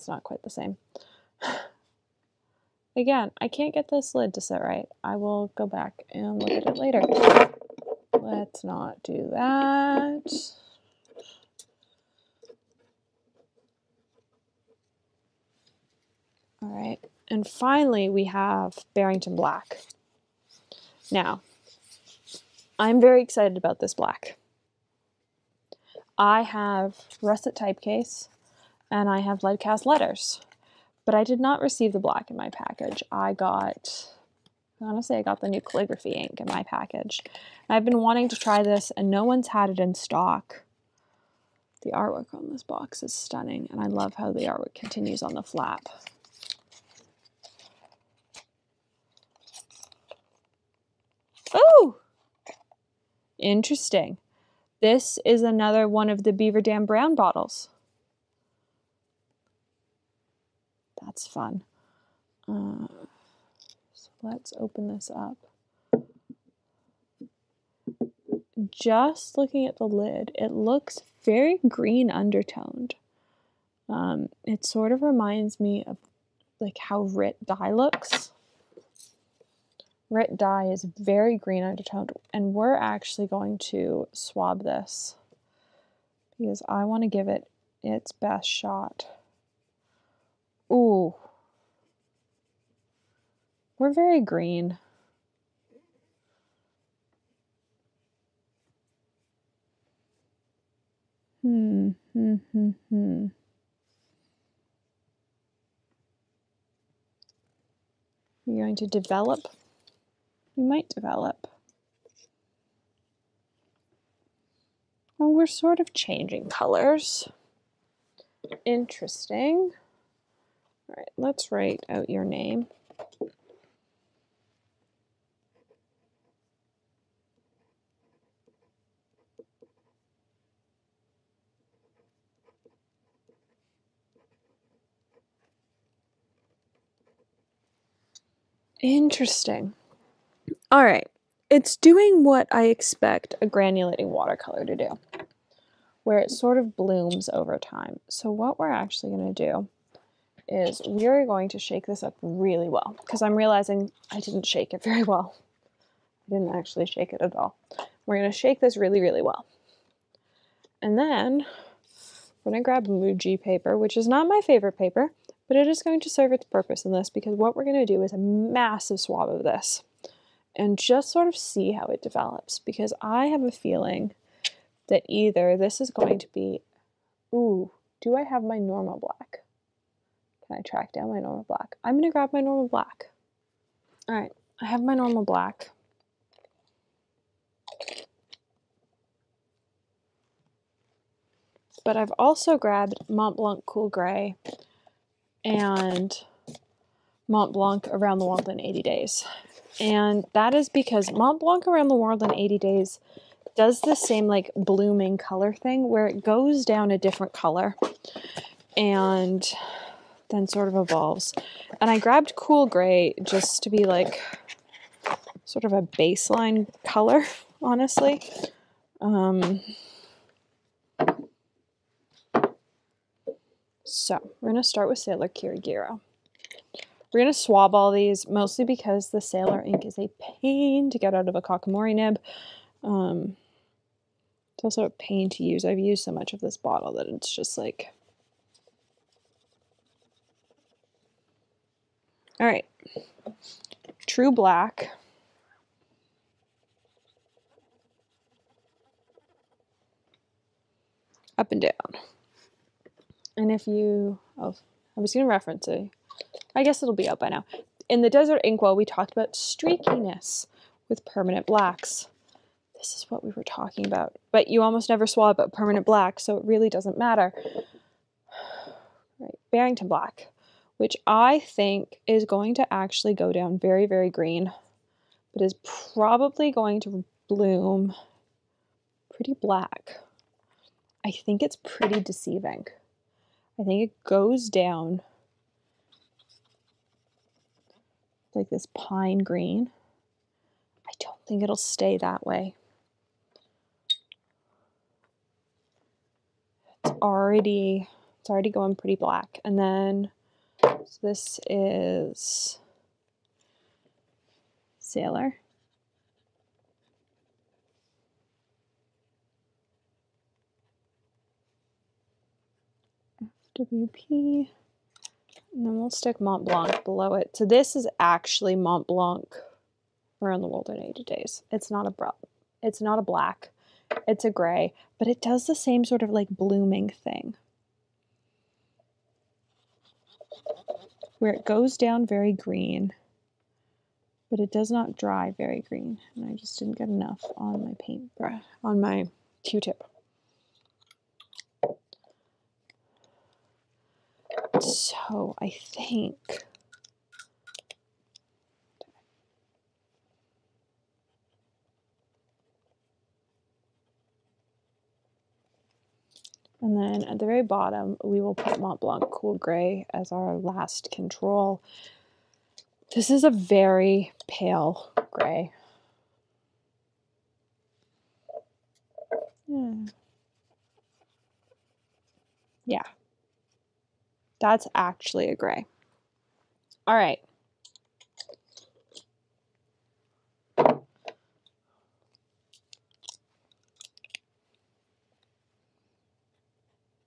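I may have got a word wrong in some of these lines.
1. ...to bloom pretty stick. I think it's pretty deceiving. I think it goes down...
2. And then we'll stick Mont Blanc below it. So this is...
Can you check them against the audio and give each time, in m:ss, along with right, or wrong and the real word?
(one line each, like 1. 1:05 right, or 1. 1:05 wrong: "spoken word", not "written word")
1. 4:36 wrong: "black", not "stick"
2. 5:14 right.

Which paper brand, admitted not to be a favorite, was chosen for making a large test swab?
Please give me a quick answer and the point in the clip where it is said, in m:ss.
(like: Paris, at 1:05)
Muji, at 2:42.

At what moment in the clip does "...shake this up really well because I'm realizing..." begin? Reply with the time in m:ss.
2:31.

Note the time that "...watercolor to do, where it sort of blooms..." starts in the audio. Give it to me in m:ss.
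2:24.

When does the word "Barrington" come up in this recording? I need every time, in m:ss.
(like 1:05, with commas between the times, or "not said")
0:18, 4:29.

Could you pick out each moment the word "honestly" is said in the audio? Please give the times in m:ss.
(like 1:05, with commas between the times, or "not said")
0:34, 3:37.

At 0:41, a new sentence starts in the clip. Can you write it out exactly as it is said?
The artwork on this box is stunning and I love how the artwork continues on the flap.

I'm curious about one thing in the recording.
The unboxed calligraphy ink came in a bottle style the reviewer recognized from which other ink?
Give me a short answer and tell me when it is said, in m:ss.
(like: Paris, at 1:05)
Beaver Dam Brown, at 0:56.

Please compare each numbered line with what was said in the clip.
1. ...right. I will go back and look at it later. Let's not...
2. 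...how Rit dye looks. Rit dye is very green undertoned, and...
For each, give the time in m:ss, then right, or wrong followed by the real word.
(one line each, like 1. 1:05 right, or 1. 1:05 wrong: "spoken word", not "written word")
1. 0:04 right
2. 1:16 right.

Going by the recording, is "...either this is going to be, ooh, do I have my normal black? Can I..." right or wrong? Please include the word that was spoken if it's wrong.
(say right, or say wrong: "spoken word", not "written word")
right.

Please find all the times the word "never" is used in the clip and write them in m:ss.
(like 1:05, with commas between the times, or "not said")
4:24.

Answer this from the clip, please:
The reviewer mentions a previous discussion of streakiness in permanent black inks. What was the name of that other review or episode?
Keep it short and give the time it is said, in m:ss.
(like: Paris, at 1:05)
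Desert Inkwell, at 4:18.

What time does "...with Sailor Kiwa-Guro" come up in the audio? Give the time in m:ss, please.
3:44.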